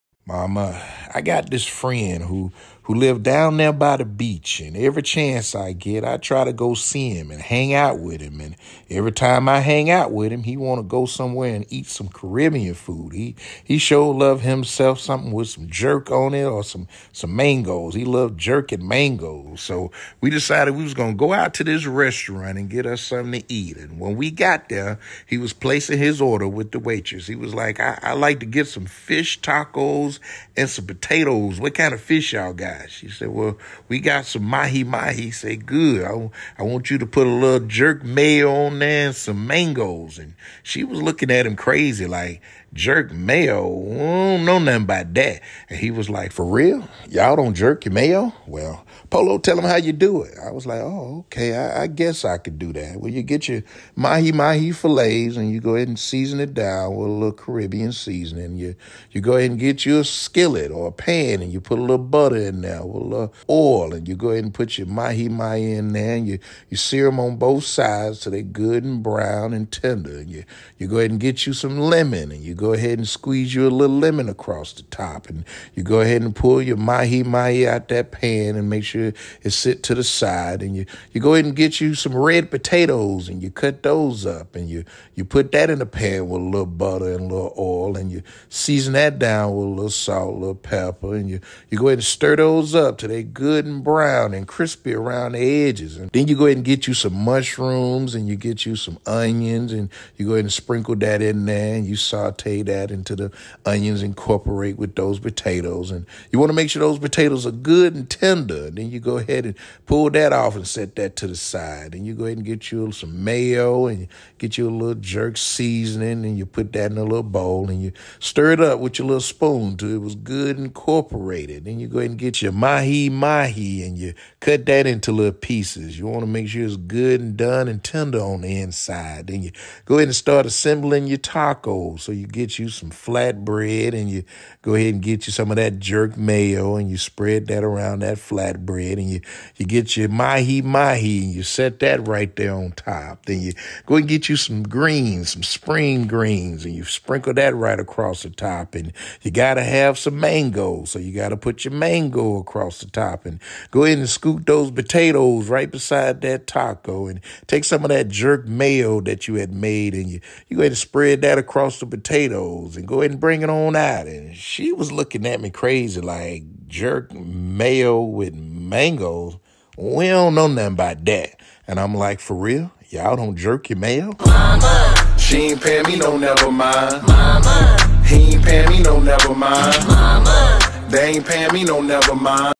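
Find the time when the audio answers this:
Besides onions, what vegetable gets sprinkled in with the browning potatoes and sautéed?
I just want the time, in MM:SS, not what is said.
01:37.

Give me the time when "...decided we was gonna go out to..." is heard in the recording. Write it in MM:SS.
00:20.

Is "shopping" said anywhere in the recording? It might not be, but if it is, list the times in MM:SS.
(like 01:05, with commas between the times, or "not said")
not said.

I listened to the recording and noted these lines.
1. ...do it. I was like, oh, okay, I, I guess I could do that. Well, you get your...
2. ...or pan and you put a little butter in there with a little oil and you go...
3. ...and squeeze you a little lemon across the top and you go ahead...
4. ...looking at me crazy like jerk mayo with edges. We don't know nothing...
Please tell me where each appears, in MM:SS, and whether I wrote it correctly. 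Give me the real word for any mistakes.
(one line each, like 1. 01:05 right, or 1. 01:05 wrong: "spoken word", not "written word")
1. 00:49 right
2. 01:00 right
3. 01:12 right
4. 02:44 wrong: "mangoes", not "edges".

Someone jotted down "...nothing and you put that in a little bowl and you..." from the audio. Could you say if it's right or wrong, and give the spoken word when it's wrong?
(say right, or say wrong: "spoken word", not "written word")
wrong: "seasoning", not "nothing".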